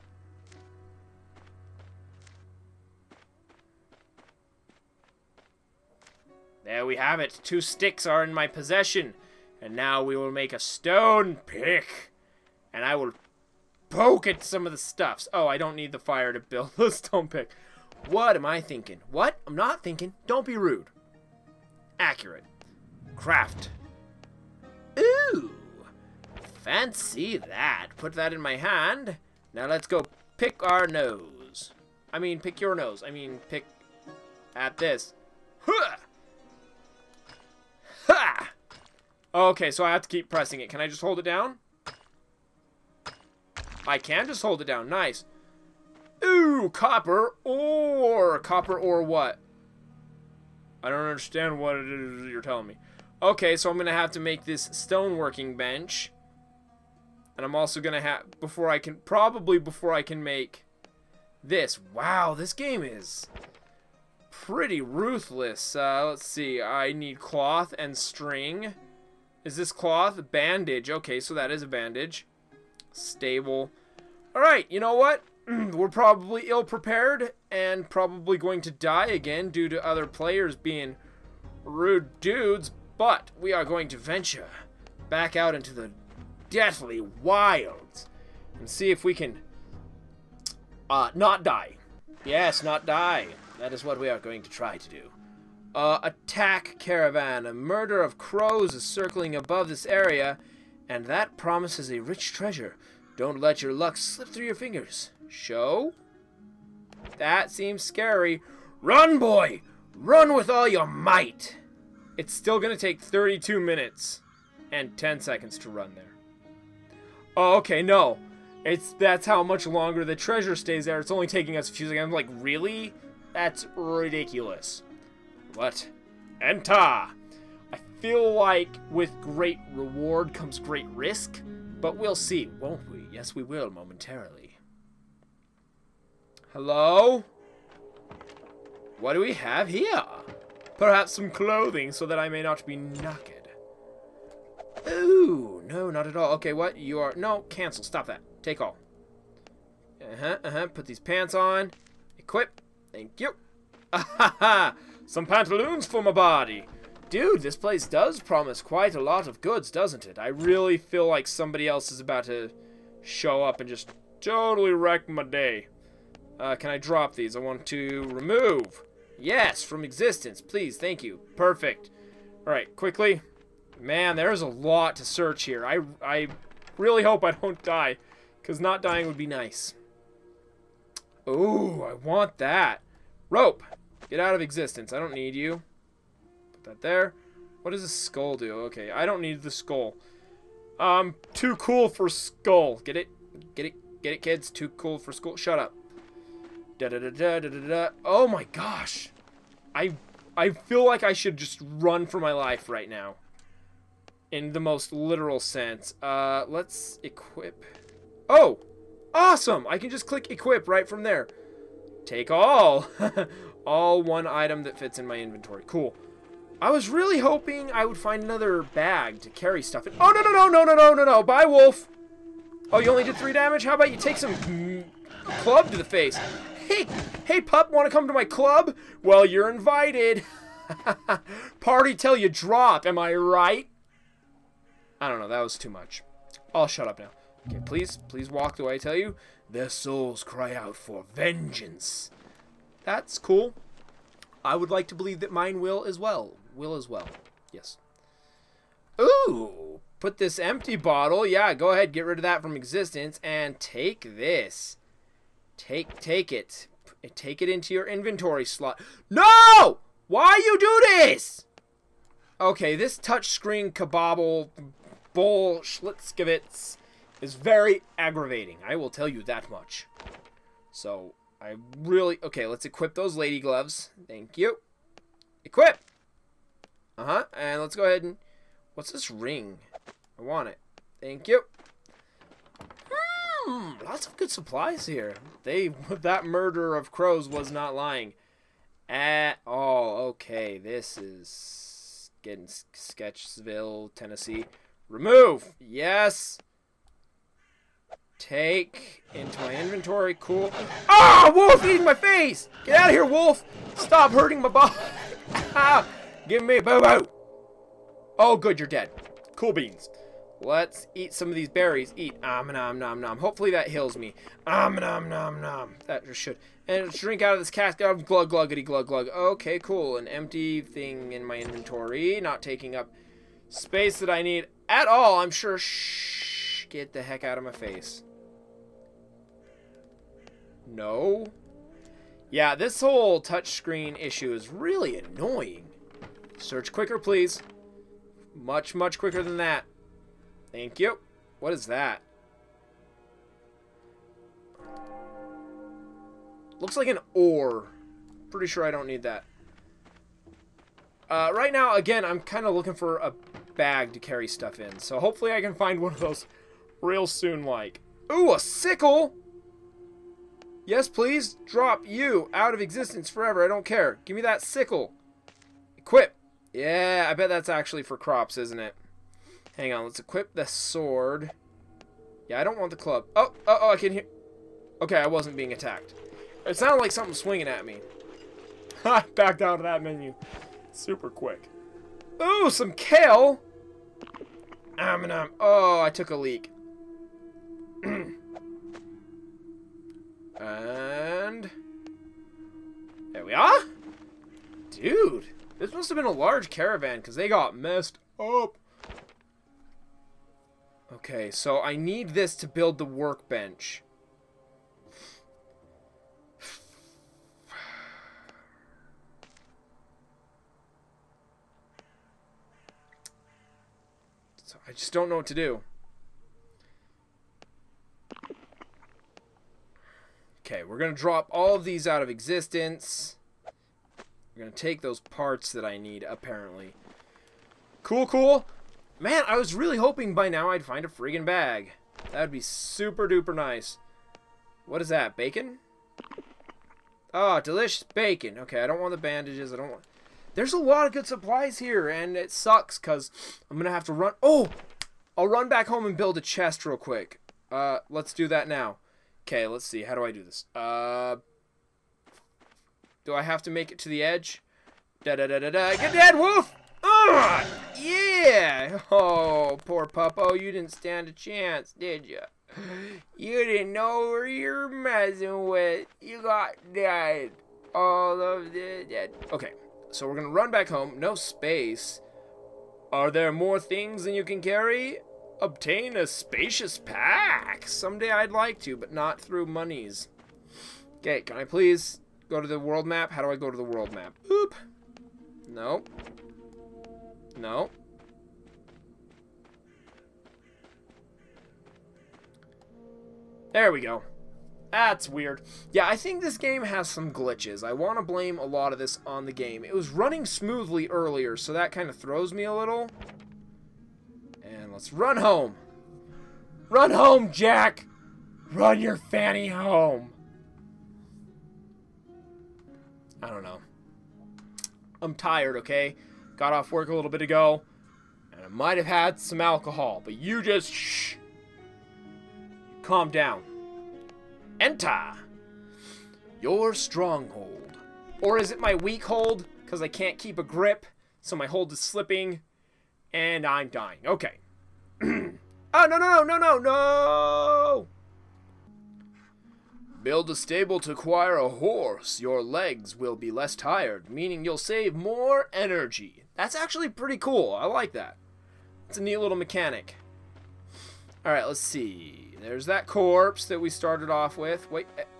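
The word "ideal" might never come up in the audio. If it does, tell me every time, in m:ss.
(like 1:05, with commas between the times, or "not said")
not said.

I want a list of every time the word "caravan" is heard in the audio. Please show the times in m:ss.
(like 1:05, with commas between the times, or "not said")
1:36, 6:36.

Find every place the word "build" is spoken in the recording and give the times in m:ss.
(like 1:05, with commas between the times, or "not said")
0:16, 6:42, 7:25, 9:00.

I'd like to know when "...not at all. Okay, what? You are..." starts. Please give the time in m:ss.
2:25.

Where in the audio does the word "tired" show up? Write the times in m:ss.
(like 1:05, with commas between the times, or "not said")
8:35, 9:03.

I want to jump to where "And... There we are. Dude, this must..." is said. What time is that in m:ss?
6:30.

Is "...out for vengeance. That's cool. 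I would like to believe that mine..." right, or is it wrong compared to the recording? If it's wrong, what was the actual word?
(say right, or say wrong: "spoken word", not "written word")
right.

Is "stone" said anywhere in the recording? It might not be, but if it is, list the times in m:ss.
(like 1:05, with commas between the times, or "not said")
0:10, 0:16, 0:54.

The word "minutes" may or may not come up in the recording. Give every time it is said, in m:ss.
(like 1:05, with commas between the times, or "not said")
1:53.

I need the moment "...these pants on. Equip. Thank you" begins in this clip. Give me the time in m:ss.
2:30.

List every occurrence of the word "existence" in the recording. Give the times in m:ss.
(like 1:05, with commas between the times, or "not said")
2:49, 3:04, 4:12, 6:02, 7:02.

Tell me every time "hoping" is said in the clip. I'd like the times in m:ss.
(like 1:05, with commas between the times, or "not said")
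3:37, 7:09.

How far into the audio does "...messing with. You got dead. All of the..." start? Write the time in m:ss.
7:44.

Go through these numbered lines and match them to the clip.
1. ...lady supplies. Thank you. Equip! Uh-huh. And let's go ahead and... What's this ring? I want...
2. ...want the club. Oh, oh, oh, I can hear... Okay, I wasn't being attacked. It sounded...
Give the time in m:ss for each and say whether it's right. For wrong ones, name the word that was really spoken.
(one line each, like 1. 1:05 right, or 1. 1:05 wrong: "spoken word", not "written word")
1. 4:33 wrong: "gloves", not "supplies"
2. 6:12 right.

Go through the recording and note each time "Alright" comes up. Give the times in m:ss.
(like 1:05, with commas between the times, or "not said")
1:14, 2:52.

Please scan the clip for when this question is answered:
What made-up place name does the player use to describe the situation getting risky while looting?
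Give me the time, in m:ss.
4:52.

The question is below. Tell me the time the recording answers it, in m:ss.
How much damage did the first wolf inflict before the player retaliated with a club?
3:43.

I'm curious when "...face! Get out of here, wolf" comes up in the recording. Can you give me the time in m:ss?
5:01.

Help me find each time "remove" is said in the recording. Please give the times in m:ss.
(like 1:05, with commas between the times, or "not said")
2:48, 4:54.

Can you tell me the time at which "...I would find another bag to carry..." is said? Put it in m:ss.
3:37.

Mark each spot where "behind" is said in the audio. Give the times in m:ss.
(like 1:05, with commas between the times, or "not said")
not said.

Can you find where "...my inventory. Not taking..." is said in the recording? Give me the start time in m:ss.
5:21.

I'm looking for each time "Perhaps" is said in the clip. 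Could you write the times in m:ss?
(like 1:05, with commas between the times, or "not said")
2:20.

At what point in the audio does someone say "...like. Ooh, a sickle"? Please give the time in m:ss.
5:57.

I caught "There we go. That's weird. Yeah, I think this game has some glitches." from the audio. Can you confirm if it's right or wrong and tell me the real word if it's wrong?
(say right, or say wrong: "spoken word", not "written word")
right.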